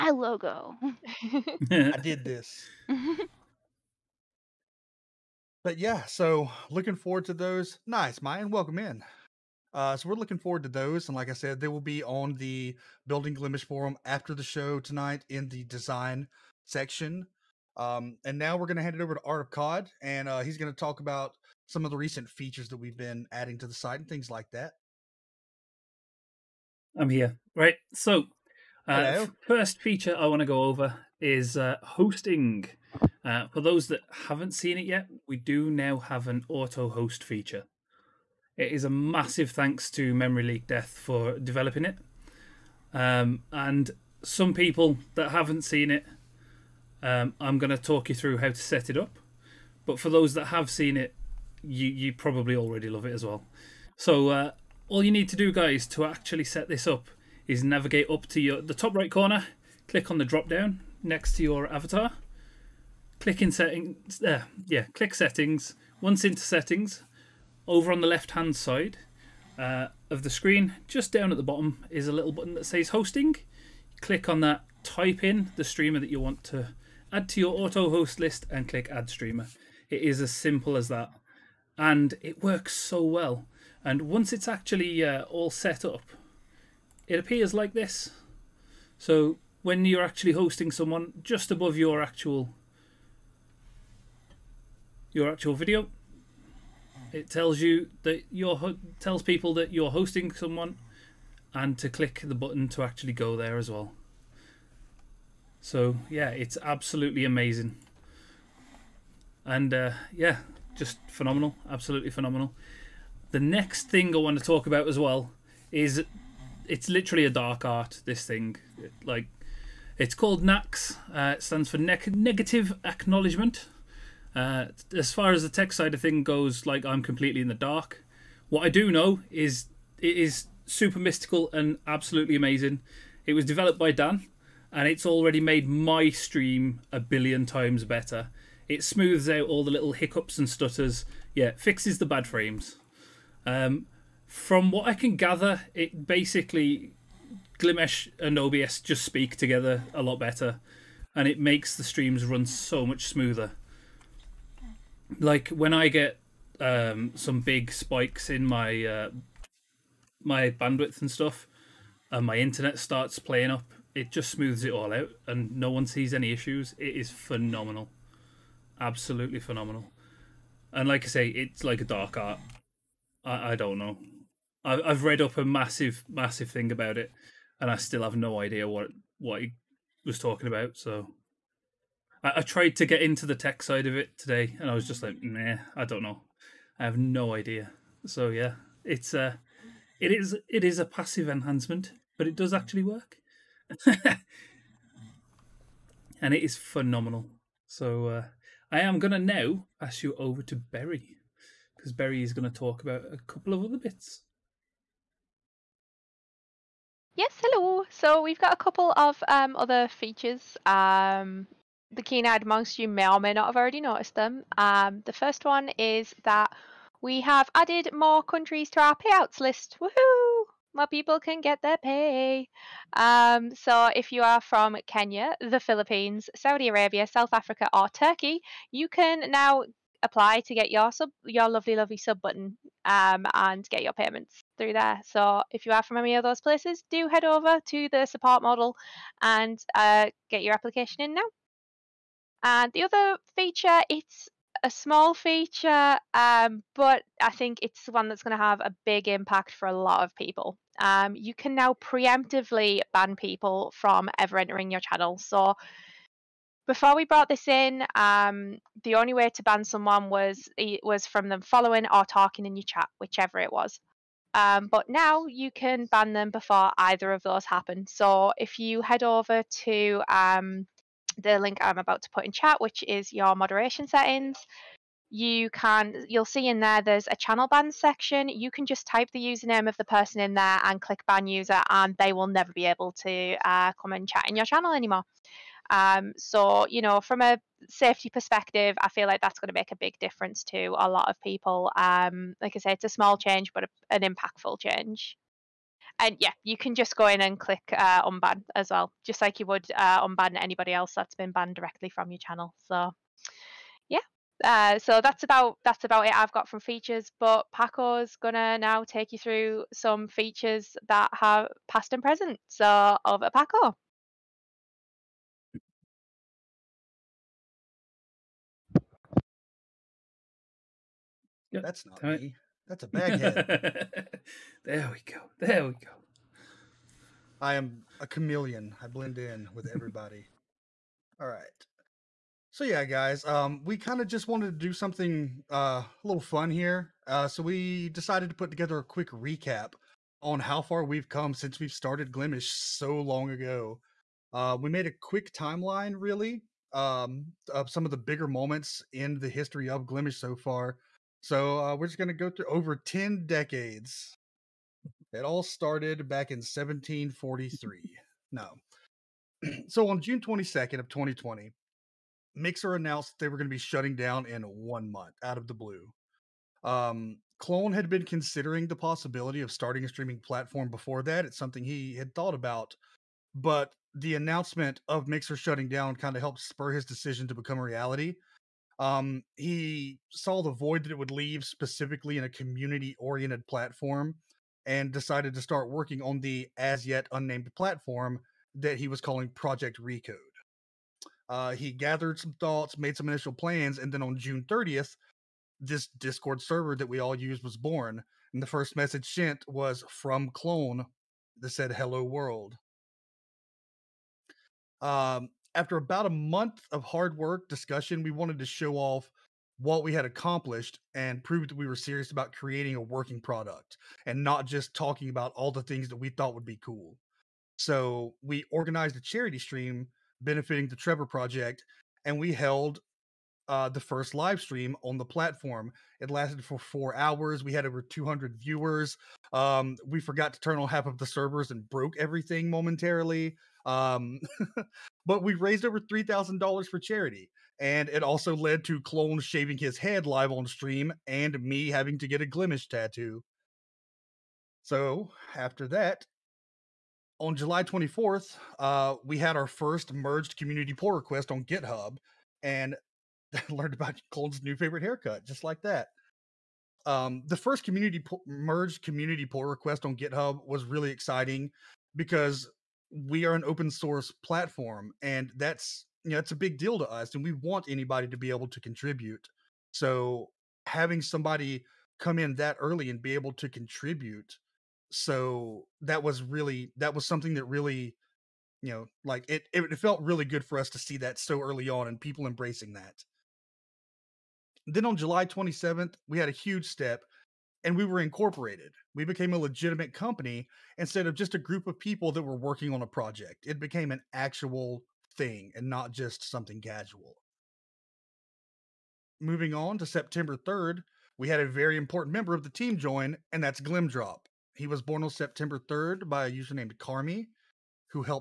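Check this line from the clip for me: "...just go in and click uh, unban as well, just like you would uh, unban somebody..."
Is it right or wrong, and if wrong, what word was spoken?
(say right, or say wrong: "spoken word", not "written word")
wrong: "anybody", not "somebody".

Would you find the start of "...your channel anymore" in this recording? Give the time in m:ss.
4:44.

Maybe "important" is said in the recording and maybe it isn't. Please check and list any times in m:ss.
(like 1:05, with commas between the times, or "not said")
8:21.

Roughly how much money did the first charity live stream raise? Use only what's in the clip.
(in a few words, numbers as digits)
$3,000.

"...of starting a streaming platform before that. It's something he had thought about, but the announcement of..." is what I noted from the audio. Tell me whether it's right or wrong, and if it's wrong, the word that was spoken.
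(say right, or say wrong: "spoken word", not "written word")
right.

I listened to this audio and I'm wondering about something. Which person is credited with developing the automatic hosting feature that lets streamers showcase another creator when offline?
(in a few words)
Memory Leak Death.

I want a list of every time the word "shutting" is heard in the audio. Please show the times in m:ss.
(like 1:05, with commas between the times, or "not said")
6:03, 6:15.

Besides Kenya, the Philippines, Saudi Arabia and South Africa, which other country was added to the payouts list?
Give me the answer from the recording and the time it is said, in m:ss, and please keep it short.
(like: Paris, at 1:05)
Turkey, at 3:47.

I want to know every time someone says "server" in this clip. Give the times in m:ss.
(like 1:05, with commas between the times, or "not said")
6:36, 7:11.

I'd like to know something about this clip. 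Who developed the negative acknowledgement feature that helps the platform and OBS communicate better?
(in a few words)
Dan.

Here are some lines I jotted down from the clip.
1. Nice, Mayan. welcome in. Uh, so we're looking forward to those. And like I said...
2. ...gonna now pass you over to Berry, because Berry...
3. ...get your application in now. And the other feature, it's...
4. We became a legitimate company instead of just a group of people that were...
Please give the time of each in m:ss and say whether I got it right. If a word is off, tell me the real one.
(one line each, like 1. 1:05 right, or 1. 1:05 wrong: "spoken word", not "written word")
1. 0:07 right
2. 3:18 right
3. 4:00 right
4. 8:08 right.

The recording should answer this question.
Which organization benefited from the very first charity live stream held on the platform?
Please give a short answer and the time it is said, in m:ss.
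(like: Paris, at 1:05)
The Trevor Project, at 7:00.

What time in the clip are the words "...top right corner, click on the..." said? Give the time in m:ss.
0:58.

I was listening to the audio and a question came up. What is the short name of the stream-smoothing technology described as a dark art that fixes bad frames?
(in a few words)
Nax.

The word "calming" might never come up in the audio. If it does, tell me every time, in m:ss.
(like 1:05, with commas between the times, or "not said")
not said.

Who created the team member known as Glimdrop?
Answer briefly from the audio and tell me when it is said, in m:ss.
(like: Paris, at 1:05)
Carmi, at 8:26.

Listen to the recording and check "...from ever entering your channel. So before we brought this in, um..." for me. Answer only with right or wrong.
right.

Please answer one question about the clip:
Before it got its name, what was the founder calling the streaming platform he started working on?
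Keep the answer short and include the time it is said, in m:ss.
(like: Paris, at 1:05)
Project Recode, at 6:29.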